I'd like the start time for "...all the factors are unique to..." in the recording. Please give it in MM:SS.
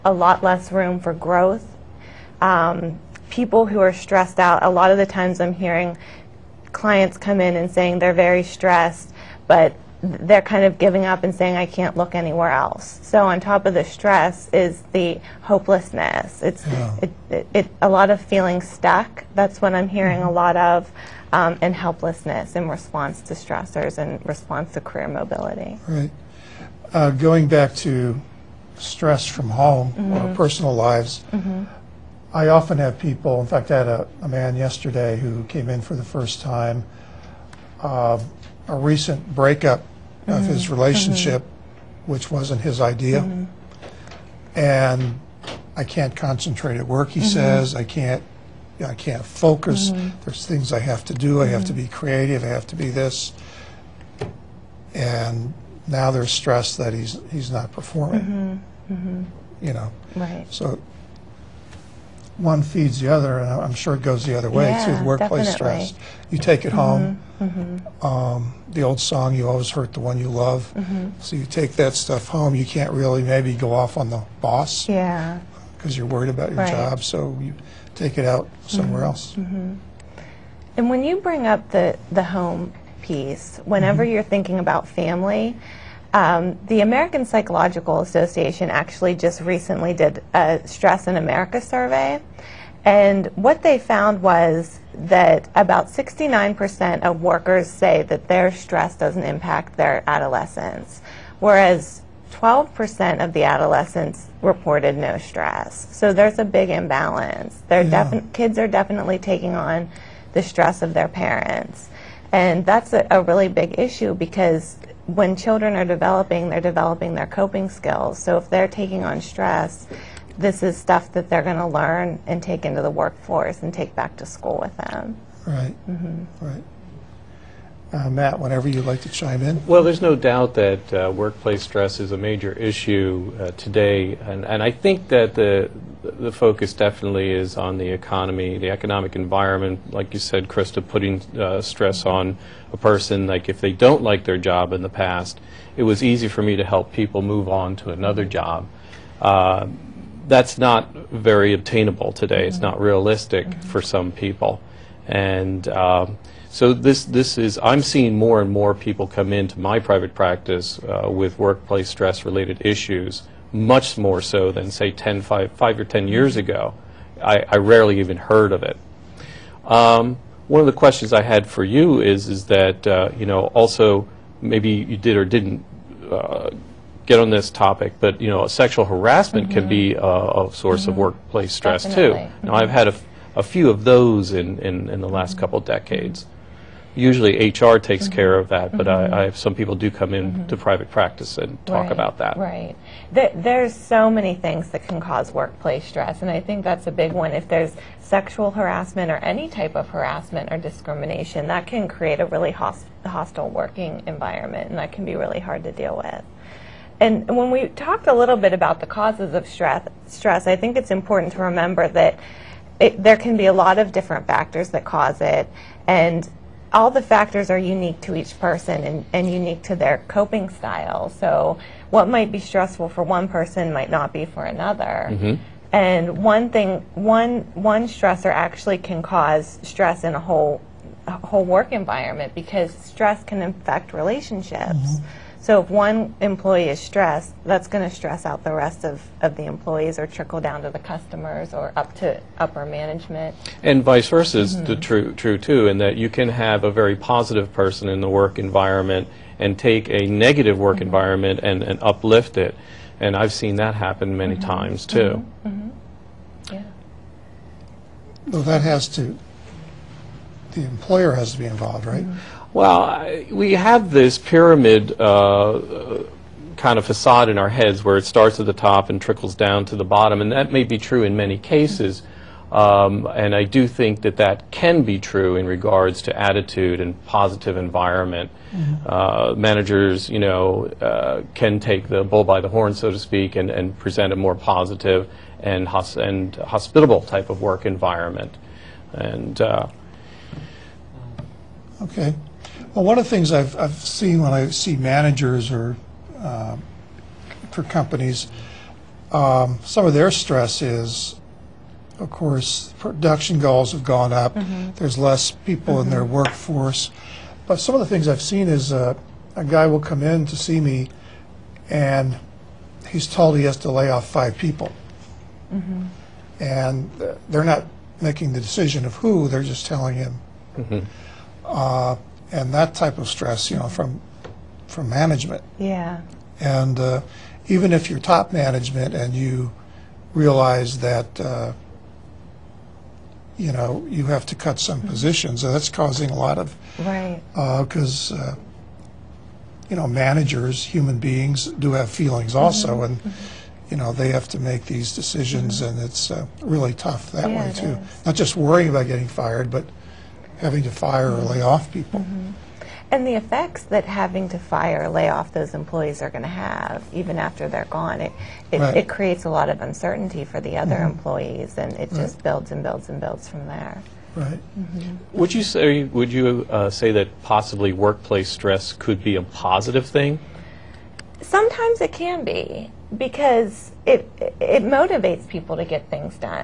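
03:36.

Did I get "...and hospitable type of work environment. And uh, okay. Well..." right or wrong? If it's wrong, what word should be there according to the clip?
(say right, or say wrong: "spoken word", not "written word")
right.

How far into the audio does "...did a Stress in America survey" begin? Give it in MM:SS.
01:29.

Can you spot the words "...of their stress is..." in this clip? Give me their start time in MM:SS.
04:59.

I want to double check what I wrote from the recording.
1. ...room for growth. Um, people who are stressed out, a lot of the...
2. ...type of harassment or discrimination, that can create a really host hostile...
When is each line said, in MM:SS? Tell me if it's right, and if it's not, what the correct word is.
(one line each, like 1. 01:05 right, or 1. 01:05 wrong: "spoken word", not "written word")
1. 00:00 right
2. 03:19 right.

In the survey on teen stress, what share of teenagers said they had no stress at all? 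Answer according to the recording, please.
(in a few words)
12%.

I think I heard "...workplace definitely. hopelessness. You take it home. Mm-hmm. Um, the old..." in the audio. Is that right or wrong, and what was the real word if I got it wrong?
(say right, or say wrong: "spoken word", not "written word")
wrong: "stress", not "hopelessness".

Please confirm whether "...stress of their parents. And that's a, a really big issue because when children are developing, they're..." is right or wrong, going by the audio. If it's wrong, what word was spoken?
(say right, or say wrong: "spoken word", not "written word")
right.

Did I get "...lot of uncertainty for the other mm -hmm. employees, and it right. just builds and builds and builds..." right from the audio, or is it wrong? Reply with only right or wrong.
right.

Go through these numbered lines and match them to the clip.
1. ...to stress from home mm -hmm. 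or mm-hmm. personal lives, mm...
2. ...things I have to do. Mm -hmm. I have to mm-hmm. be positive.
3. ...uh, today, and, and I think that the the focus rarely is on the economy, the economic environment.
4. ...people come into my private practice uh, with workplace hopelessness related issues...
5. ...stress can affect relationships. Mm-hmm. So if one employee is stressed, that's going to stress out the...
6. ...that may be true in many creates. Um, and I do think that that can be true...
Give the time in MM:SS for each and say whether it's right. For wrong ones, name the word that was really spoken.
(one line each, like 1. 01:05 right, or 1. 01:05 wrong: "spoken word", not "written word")
1. 00:27 right
2. 00:50 wrong: "creative", not "positive"
3. 02:13 wrong: "definitely", not "rarely"
4. 02:38 wrong: "stress", not "hopelessness"
5. 03:52 right
6. 04:30 wrong: "cases", not "creates".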